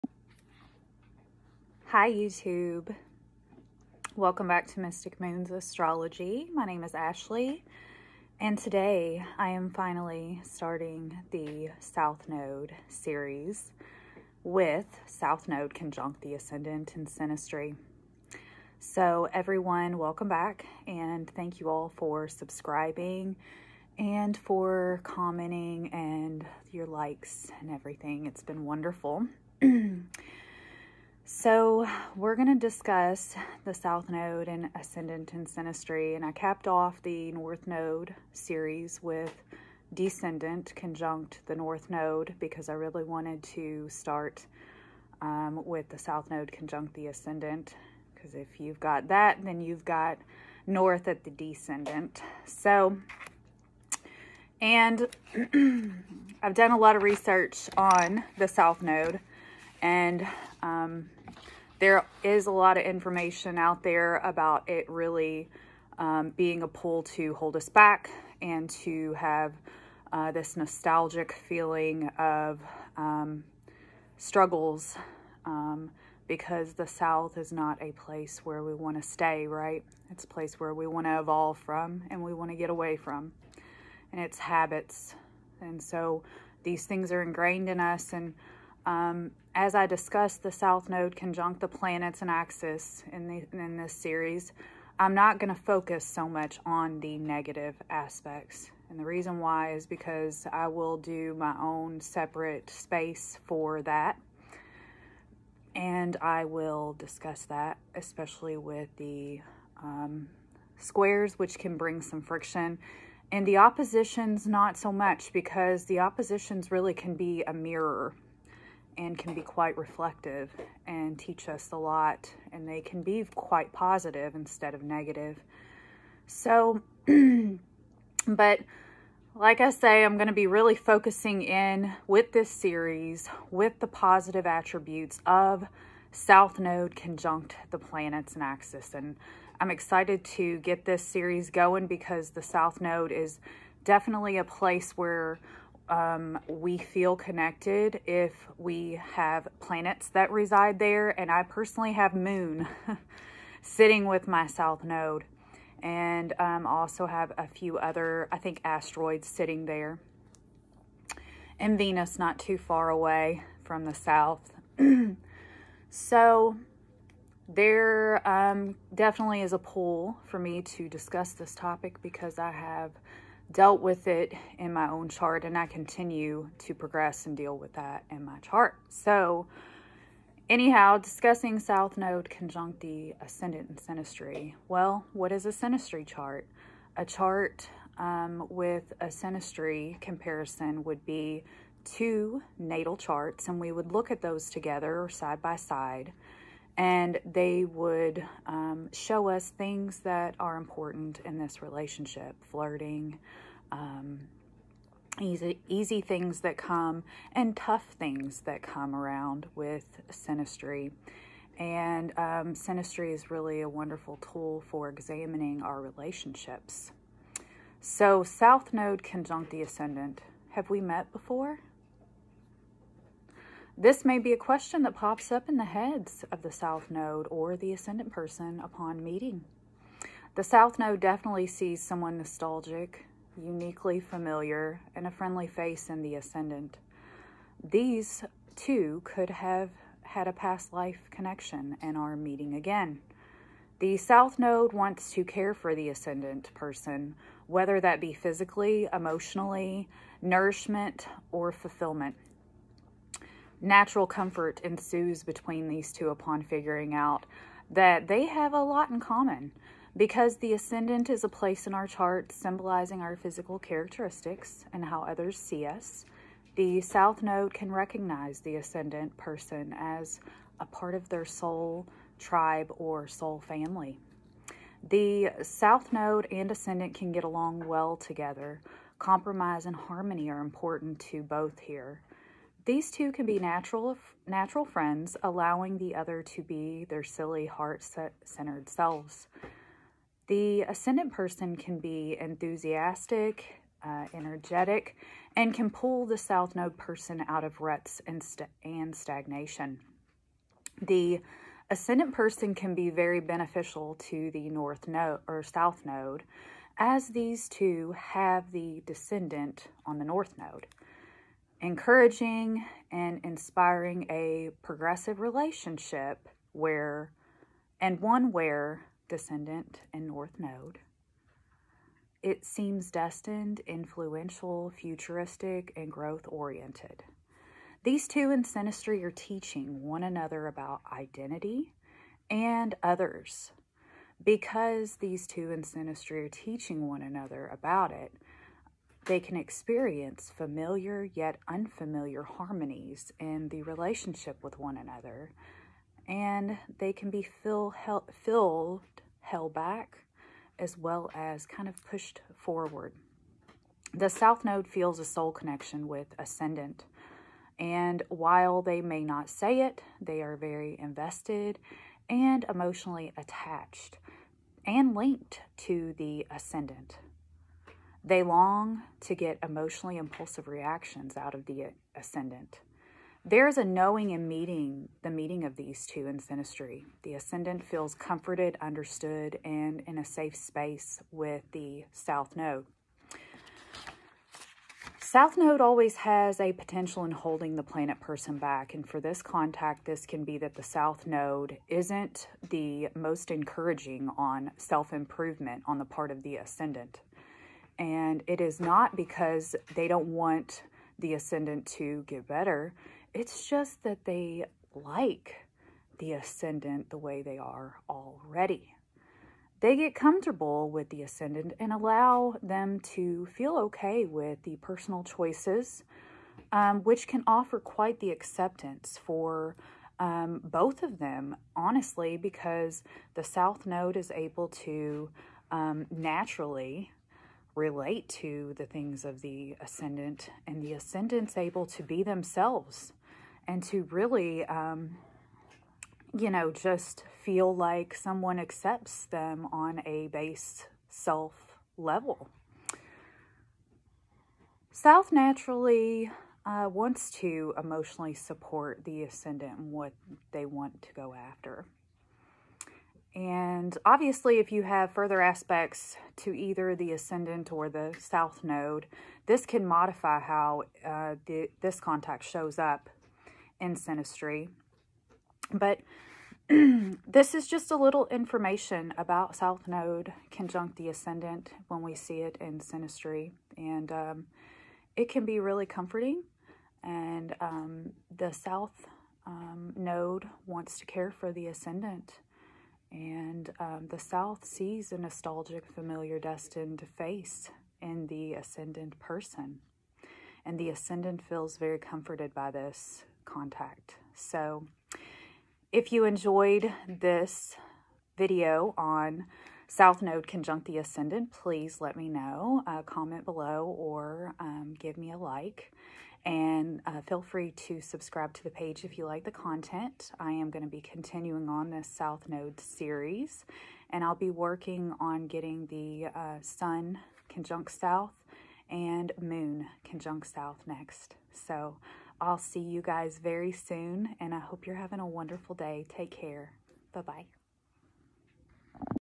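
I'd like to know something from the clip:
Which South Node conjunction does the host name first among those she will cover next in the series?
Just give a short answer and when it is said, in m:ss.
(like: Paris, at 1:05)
Sun conjunct South, at 8:36.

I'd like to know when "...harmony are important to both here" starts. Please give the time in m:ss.
4:39.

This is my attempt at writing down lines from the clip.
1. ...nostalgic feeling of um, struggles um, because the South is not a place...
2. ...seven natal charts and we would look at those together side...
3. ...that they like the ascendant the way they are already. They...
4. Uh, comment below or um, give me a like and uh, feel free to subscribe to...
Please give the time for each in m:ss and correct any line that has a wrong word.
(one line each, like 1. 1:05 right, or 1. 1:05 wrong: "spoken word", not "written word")
1. 1:10 right
2. 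3:11 wrong: "two", not "seven"
3. 6:43 right
4. 8:22 right.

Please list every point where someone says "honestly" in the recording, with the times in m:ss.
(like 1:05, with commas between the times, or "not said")
7:01.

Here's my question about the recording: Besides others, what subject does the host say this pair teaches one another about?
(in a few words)
identity.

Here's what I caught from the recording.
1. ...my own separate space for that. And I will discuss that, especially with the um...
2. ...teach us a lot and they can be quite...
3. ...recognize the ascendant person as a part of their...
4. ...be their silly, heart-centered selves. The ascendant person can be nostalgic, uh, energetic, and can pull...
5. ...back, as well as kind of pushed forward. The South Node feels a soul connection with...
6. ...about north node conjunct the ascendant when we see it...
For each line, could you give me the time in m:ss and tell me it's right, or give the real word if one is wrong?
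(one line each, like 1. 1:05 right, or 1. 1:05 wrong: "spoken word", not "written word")
1. 1:41 right
2. 2:01 right
3. 4:27 right
4. 4:46 wrong: "enthusiastic", not "nostalgic"
5. 5:49 right
6. 7:48 wrong: "south", not "north".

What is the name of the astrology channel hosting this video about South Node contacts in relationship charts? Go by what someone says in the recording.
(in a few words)
Mystic Moons Astrology.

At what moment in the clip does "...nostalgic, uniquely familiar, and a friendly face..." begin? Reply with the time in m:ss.
3:52.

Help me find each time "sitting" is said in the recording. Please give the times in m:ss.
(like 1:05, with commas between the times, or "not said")
2:33, 2:39.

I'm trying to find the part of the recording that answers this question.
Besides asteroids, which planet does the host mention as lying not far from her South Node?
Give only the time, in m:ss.
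2:41.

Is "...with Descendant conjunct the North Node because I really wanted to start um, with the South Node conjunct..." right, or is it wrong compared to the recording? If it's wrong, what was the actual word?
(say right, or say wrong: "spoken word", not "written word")
right.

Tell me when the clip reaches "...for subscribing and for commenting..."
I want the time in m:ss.
0:21.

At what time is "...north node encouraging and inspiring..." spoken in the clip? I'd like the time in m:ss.
5:10.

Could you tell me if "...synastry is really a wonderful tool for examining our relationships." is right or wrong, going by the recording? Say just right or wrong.
right.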